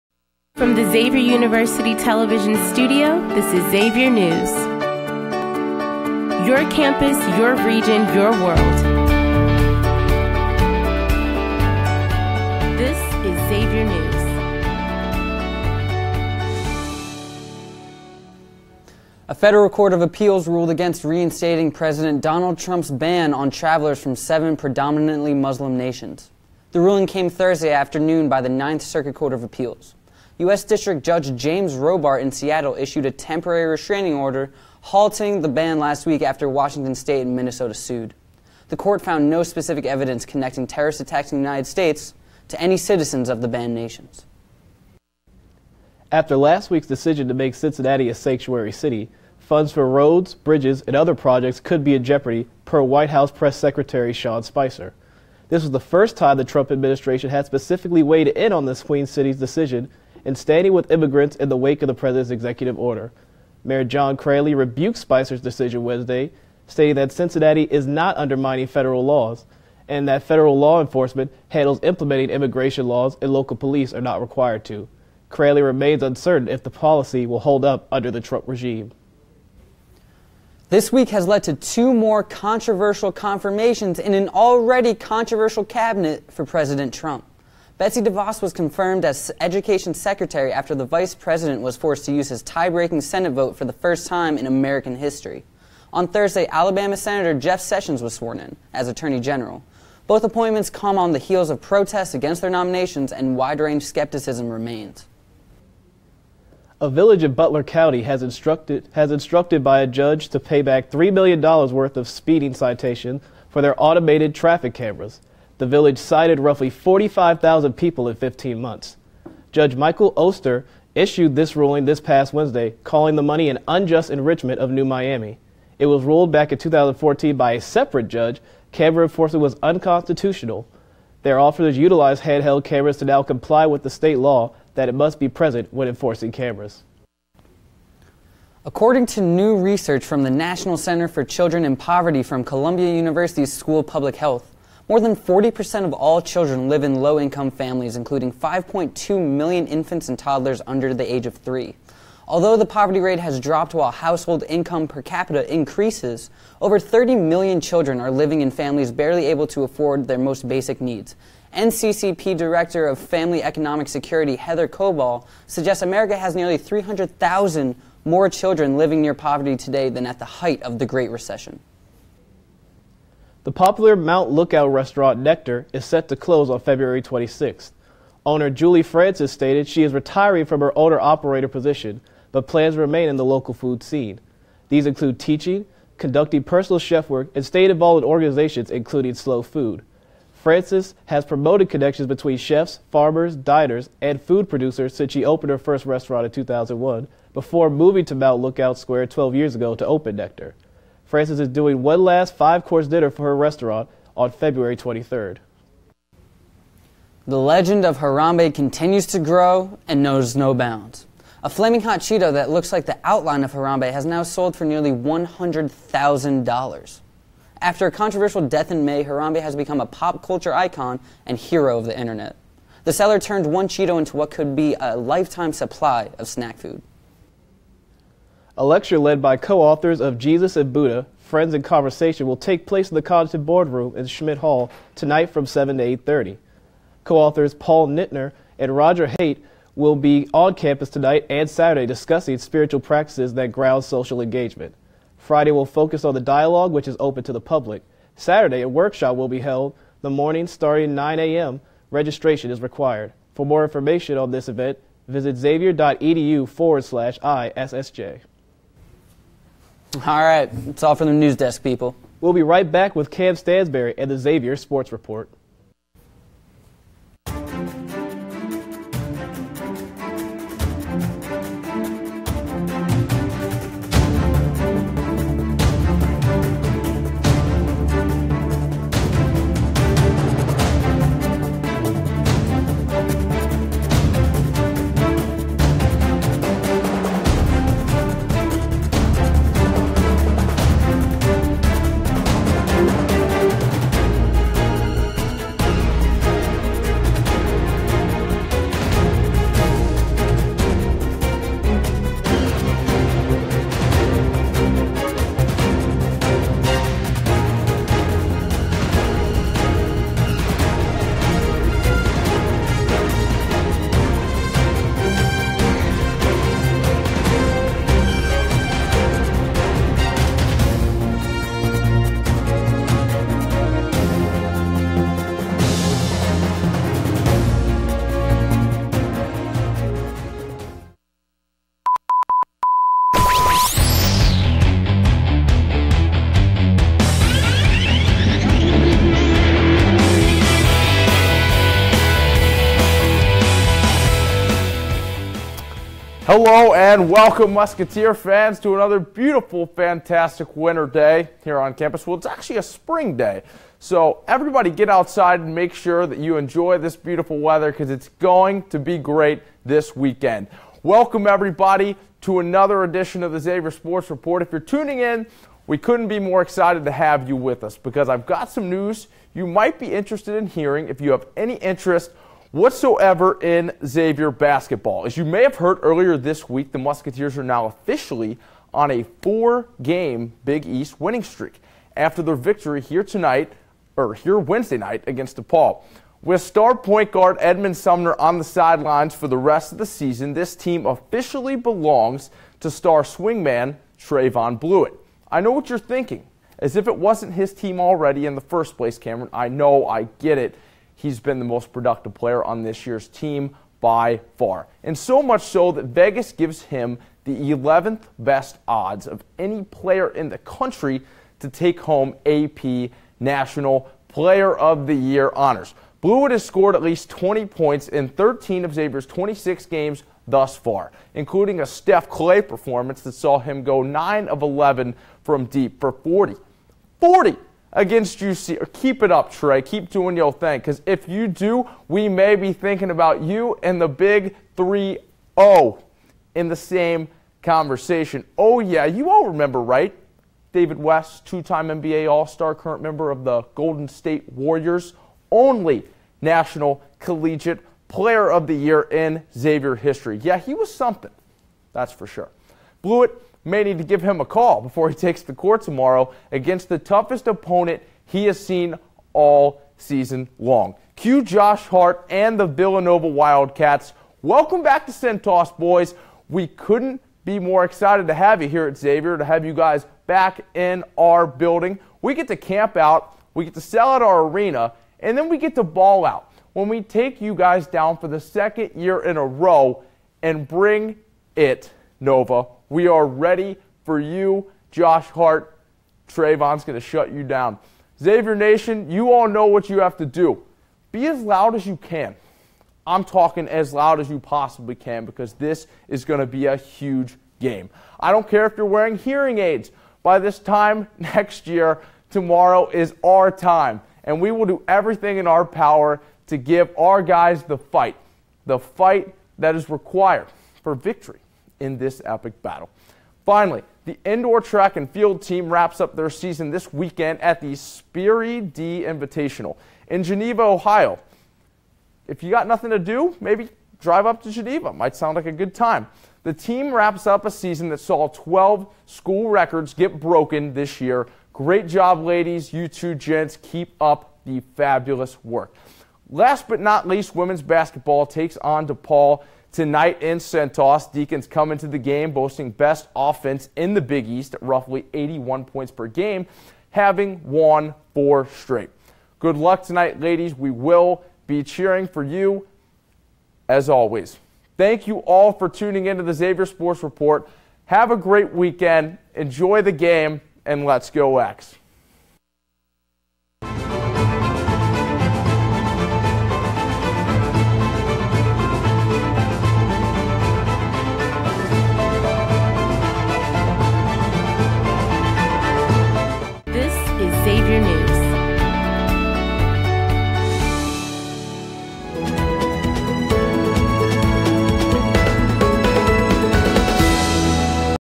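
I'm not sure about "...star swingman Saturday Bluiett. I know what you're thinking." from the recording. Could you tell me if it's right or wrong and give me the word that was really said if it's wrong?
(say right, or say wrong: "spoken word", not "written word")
wrong: "Trevon", not "Saturday".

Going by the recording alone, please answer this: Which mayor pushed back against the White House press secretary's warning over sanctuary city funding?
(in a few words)
John Cranley.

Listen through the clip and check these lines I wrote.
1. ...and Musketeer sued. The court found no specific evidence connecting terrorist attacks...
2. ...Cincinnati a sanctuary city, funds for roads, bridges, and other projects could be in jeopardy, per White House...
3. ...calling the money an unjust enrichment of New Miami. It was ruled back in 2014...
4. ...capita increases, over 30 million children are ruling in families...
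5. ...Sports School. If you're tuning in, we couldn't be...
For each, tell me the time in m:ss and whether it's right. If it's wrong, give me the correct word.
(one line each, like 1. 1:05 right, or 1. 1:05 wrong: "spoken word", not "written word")
1. 0:37 wrong: "Minnesota", not "Musketeer"
2. 0:47 right
3. 2:02 right
4. 2:35 wrong: "living", not "ruling"
5. 6:03 wrong: "Report", not "School".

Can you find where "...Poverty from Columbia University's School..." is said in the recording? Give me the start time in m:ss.
2:21.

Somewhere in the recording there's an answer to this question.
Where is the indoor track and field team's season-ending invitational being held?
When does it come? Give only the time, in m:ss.
8:40.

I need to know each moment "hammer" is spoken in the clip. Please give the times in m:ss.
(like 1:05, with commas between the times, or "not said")
not said.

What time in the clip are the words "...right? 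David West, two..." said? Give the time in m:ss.
7:19.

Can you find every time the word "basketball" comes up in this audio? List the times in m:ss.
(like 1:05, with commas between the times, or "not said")
6:14, 8:57.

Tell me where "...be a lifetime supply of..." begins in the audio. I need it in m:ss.
3:44.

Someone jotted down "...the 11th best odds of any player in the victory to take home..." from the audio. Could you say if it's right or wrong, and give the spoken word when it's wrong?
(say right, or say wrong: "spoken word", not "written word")
wrong: "country", not "victory".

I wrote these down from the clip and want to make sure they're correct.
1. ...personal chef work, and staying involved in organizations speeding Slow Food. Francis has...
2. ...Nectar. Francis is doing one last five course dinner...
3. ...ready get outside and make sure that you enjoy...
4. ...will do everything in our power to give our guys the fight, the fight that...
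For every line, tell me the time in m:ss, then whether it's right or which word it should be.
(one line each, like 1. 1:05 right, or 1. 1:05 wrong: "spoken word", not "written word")
1. 3:06 wrong: "including", not "speeding"
2. 3:20 right
3. 5:54 wrong: "everybody", not "ready"
4. 8:24 right.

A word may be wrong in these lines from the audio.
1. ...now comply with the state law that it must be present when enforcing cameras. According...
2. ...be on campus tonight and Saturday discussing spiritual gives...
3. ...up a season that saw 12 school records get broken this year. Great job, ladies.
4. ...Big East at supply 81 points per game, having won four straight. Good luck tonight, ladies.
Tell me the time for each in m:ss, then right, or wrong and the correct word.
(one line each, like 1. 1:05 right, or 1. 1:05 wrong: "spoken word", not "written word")
1. 2:13 right
2. 3:59 wrong: "practices", not "gives"
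3. 8:47 right
4. 9:03 wrong: "roughly", not "supply".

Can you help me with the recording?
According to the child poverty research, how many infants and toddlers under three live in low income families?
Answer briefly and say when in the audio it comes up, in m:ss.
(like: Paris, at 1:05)
5.2 million, at 2:28.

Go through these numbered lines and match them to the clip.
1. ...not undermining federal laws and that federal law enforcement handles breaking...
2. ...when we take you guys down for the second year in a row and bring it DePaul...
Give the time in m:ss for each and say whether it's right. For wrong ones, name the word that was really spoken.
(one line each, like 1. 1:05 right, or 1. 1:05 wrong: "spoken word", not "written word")
1. 1:07 wrong: "implementing", not "breaking"
2. 7:56 wrong: "Nova", not "DePaul".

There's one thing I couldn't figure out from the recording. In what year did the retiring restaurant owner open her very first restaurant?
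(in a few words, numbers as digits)
2001.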